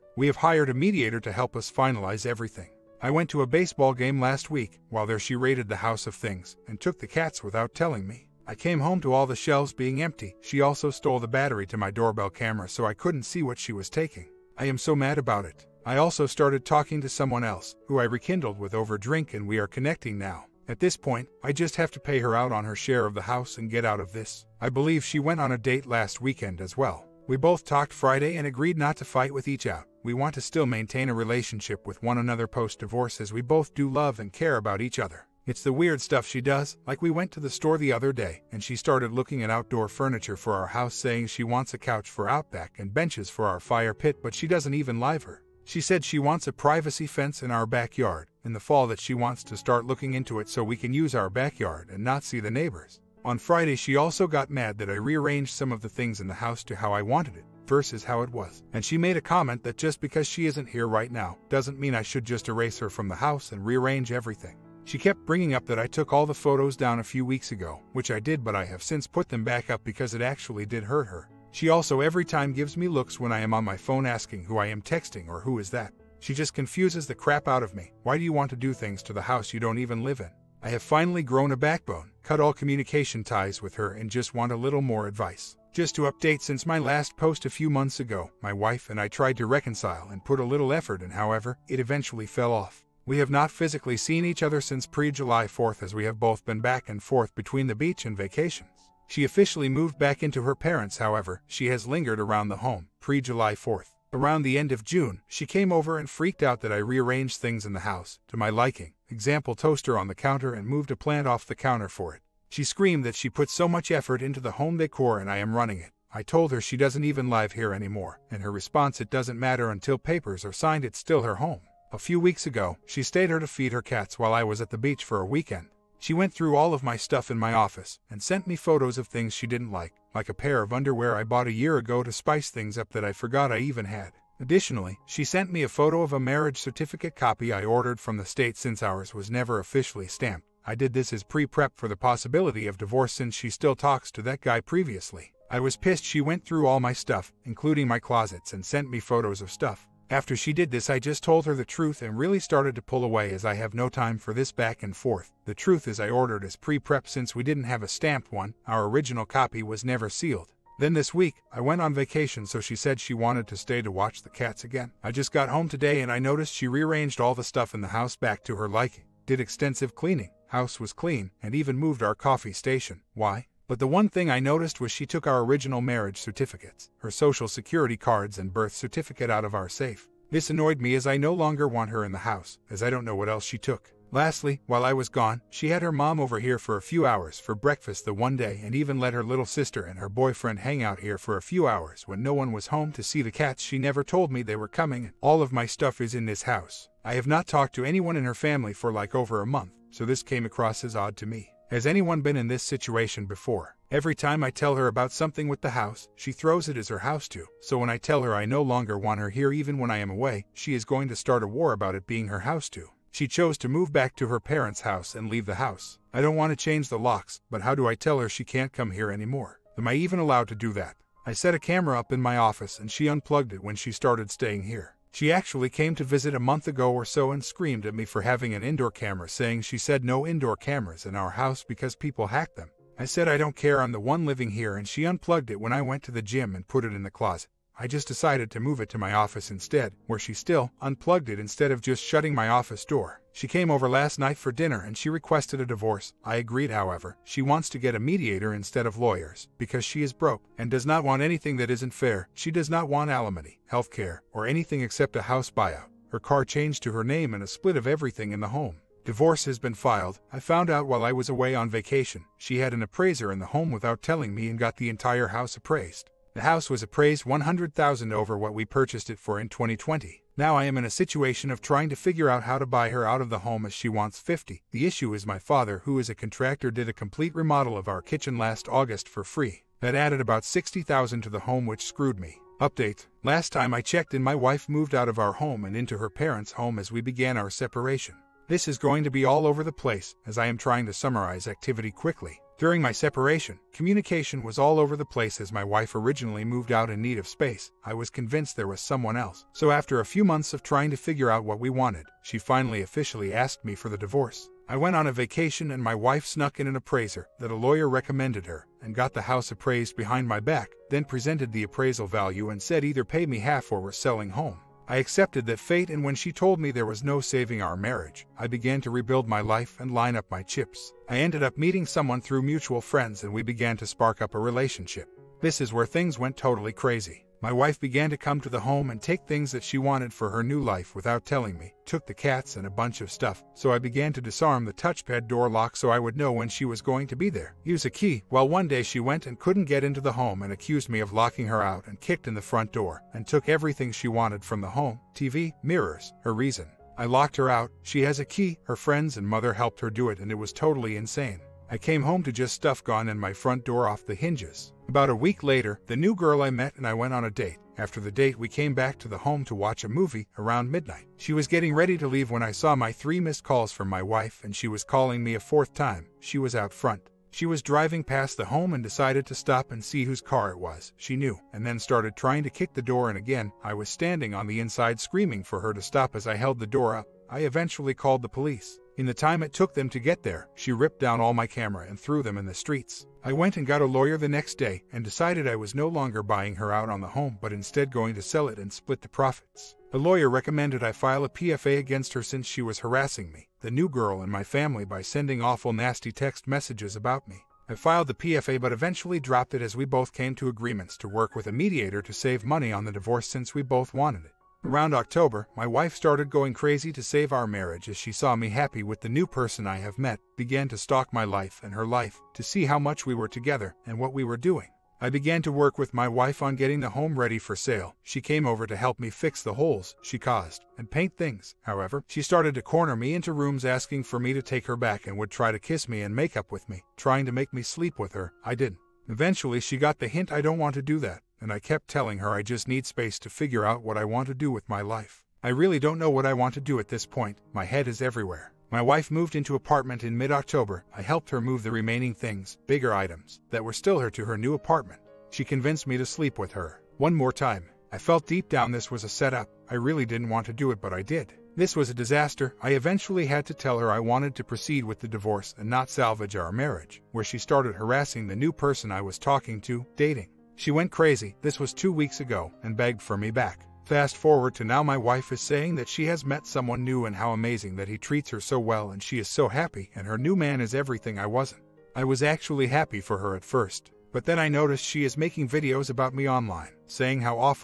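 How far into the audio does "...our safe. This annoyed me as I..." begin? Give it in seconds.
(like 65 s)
179 s.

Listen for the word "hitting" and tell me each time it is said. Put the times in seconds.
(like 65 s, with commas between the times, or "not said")
not said.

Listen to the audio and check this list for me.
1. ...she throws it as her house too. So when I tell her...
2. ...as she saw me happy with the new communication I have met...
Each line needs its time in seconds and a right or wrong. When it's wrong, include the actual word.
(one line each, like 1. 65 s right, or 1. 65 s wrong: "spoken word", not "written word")
1. 206 s right
2. 407 s wrong: "person", not "communication".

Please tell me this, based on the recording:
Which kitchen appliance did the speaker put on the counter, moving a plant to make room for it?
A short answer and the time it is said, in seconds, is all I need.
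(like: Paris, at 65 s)
Toaster, at 109 s.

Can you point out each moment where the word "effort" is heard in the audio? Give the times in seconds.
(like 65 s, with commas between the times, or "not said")
90 s, 113 s.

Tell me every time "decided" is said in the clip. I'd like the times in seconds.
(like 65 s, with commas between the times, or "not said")
238 s, 368 s, 385 s.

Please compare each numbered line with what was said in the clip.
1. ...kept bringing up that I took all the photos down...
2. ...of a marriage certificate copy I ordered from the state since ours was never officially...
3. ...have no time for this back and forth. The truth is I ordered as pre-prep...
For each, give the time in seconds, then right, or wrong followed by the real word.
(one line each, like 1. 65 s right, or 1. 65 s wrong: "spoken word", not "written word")
1. 64 s right
2. 136 s right
3. 153 s right.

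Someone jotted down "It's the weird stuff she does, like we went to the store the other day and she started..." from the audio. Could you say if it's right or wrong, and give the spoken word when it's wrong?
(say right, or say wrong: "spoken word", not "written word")
right.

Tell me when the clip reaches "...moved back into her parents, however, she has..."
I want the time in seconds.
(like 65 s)
99 s.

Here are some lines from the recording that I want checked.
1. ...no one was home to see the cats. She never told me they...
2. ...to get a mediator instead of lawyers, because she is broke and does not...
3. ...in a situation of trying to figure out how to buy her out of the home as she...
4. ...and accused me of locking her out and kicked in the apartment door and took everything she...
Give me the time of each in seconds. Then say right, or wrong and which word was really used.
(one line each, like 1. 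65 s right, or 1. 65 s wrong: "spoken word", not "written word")
1. 192 s right
2. 247 s right
3. 270 s right
4. 340 s wrong: "front", not "apartment".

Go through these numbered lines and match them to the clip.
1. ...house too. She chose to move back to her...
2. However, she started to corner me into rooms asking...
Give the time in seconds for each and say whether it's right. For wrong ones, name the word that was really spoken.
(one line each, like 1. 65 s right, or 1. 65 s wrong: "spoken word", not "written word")
1. 212 s right
2. 421 s right.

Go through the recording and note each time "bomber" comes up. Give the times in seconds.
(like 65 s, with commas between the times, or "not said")
not said.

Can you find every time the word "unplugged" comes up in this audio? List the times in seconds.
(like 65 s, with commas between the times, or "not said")
223 s, 235 s, 240 s.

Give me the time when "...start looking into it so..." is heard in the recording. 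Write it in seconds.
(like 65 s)
49 s.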